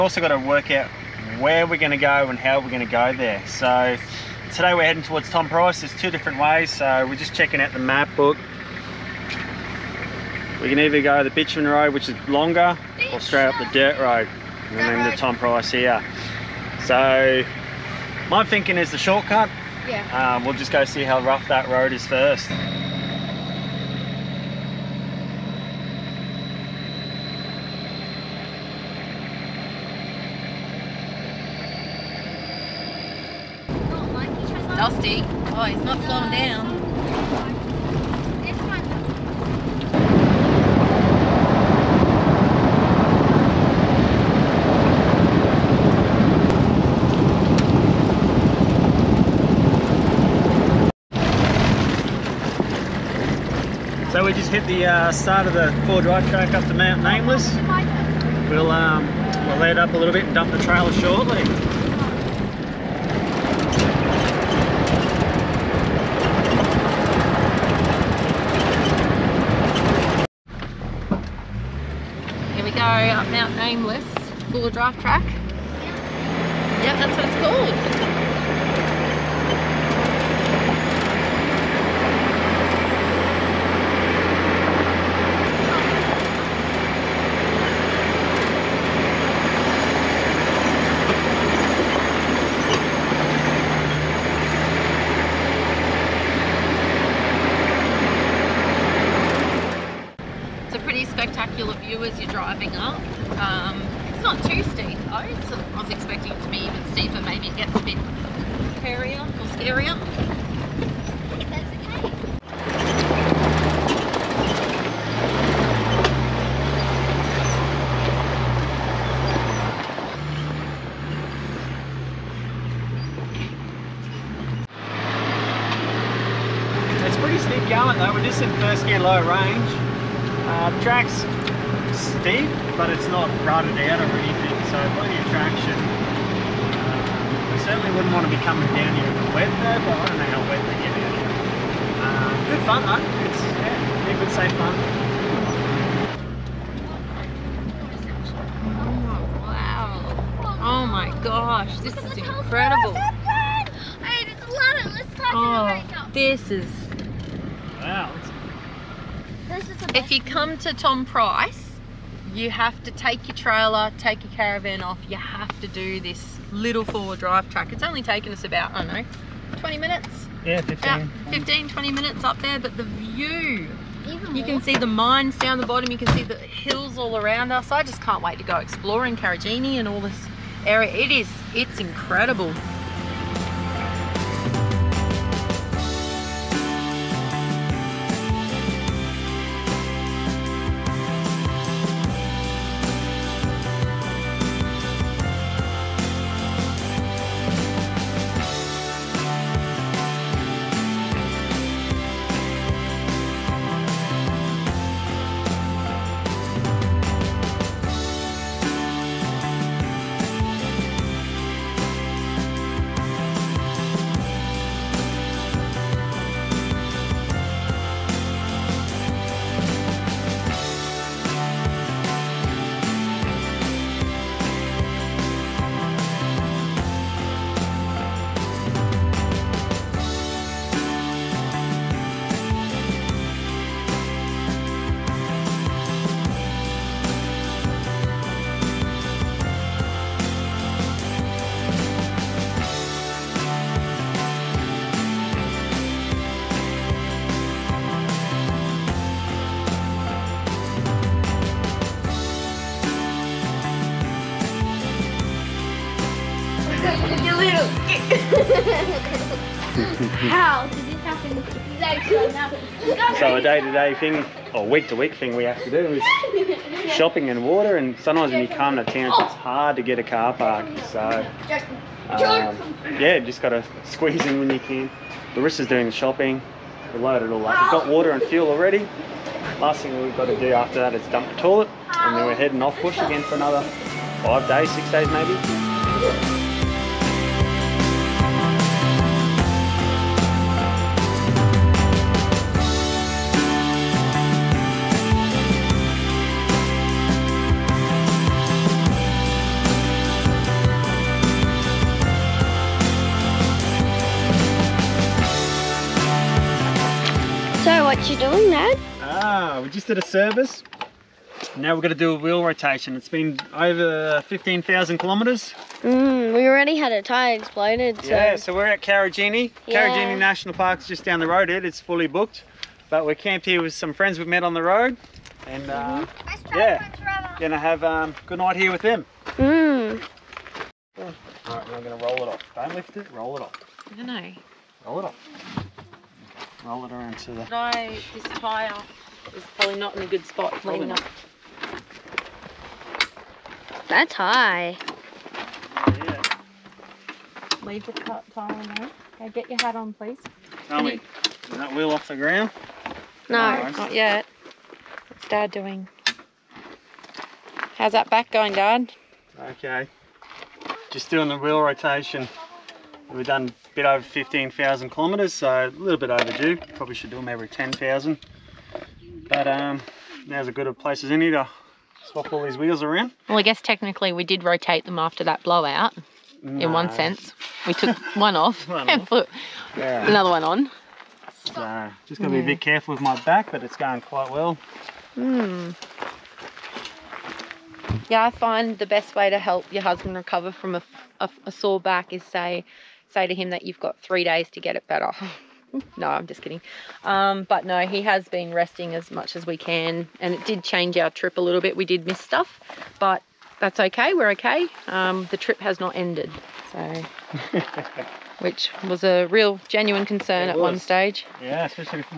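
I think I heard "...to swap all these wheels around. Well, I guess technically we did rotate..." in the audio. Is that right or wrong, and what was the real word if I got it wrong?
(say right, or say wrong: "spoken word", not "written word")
right.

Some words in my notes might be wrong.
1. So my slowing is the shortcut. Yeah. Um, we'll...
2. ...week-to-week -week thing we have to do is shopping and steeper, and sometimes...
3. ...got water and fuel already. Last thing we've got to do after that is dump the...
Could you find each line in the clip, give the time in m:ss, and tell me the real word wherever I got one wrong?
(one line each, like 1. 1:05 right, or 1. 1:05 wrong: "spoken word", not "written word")
1. 0:16 wrong: "thinking", not "slowing"
2. 4:24 wrong: "water", not "steeper"
3. 4:37 right.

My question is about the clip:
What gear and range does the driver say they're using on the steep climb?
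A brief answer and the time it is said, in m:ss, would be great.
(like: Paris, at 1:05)
first gear low range, at 2:08.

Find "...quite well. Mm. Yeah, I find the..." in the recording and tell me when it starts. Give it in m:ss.
6:24.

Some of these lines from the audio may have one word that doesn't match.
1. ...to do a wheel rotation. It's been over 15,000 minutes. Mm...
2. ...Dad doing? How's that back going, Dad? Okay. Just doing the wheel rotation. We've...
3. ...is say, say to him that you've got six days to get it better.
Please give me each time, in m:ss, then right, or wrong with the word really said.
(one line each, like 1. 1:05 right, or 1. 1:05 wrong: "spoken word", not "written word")
1. 5:11 wrong: "kilometres", not "minutes"
2. 5:55 right
3. 6:32 wrong: "three", not "six".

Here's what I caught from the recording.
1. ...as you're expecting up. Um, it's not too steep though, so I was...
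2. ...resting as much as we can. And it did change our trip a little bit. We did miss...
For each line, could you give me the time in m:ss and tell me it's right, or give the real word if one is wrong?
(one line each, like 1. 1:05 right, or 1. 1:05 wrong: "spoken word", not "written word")
1. 1:42 wrong: "driving", not "expecting"
2. 6:38 right.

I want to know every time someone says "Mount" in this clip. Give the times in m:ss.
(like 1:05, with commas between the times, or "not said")
0:56, 1:13.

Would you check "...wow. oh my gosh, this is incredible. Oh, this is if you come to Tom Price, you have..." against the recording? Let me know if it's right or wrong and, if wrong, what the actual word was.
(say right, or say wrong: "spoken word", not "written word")
right.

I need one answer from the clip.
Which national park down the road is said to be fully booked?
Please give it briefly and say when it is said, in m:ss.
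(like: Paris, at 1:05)
Karijini National Park, at 5:19.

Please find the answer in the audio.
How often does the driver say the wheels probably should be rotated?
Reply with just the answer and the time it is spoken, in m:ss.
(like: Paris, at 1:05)
every 10,000 kilometres, at 6:07.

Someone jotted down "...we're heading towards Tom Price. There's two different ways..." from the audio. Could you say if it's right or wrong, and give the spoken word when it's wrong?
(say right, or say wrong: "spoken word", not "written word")
right.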